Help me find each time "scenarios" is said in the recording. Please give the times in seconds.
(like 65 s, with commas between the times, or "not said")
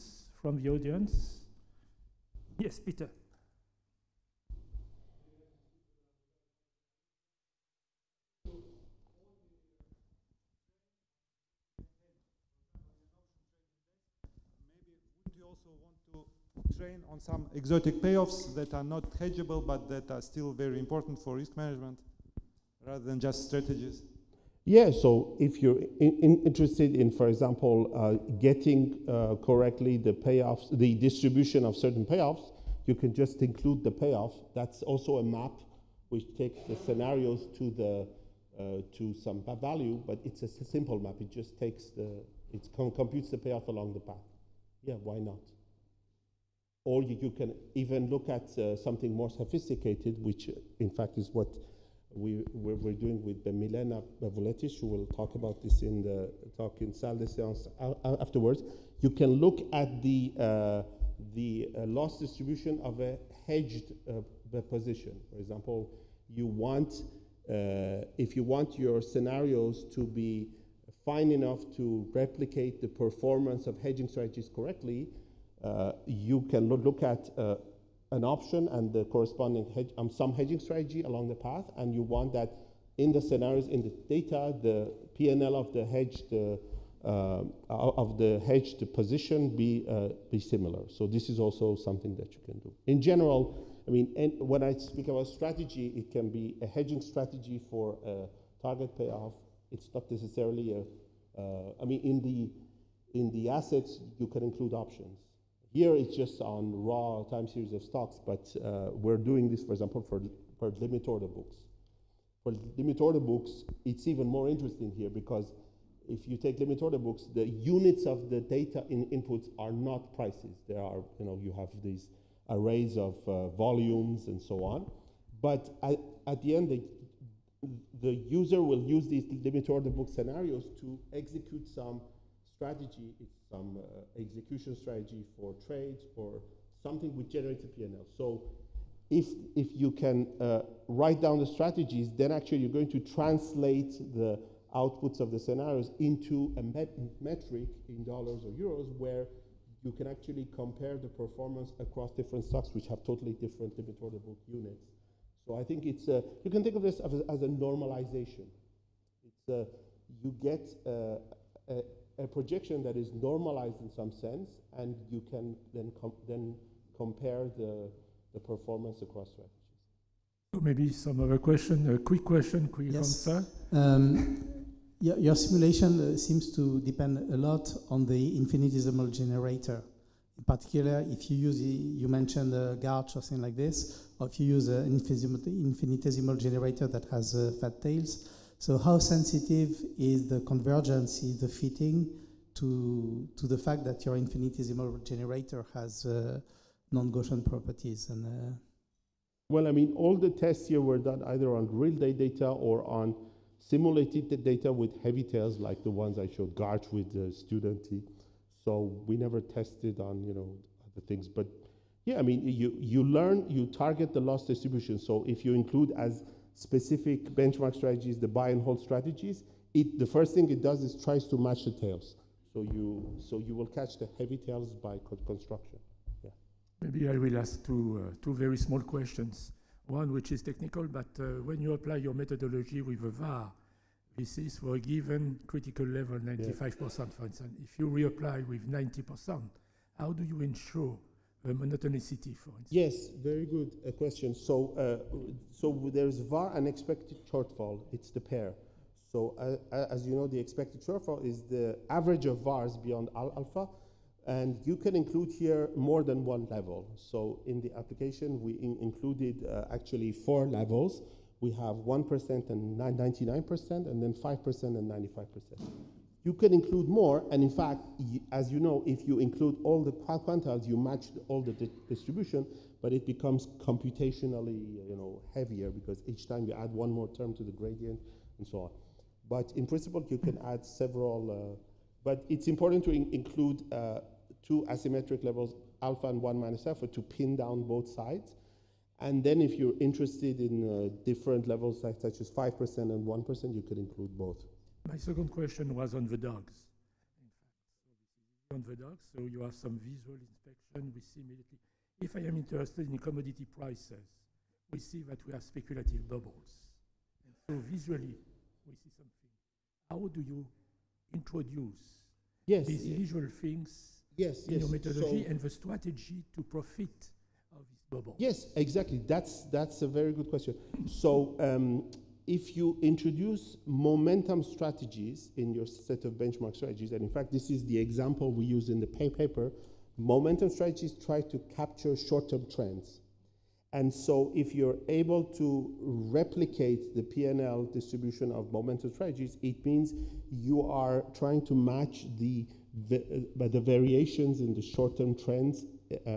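36 s, 69 s, 83 s, 130 s, 145 s.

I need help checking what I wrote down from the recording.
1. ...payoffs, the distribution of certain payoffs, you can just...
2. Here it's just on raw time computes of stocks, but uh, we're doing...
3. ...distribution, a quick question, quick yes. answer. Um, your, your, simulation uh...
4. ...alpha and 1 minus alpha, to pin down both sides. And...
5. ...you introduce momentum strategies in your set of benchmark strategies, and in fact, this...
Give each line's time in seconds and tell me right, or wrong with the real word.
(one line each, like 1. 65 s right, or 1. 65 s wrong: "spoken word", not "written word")
1. 30 s right
2. 105 s wrong: "series", not "computes"
3. 171 s wrong: "question", not "distribution"
4. 285 s right
5. 322 s right.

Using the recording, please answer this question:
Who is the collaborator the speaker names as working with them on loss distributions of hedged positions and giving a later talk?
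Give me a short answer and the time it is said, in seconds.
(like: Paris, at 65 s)
Milena Vuletic, at 53 s.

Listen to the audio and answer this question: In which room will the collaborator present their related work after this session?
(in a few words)
Salle de Séance.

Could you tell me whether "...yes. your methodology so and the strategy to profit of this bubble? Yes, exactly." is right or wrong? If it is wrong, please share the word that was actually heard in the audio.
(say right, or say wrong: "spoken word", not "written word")
right.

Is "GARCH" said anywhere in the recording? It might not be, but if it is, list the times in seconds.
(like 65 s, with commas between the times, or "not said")
182 s, 206 s.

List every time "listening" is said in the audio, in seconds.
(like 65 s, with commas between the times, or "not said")
not said.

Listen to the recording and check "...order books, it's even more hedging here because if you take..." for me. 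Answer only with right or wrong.
wrong.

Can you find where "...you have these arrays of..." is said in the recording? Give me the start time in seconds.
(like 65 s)
121 s.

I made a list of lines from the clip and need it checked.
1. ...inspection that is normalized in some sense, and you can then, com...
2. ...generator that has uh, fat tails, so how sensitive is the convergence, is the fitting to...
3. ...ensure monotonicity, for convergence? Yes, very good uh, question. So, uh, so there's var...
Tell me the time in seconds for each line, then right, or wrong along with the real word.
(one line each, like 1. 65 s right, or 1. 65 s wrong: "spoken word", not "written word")
1. 162 s wrong: "projection", not "inspection"
2. 186 s right
3. 240 s wrong: "instance", not "convergence".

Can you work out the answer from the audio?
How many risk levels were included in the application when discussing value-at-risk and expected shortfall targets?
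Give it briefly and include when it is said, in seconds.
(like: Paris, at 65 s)
4, at 260 s.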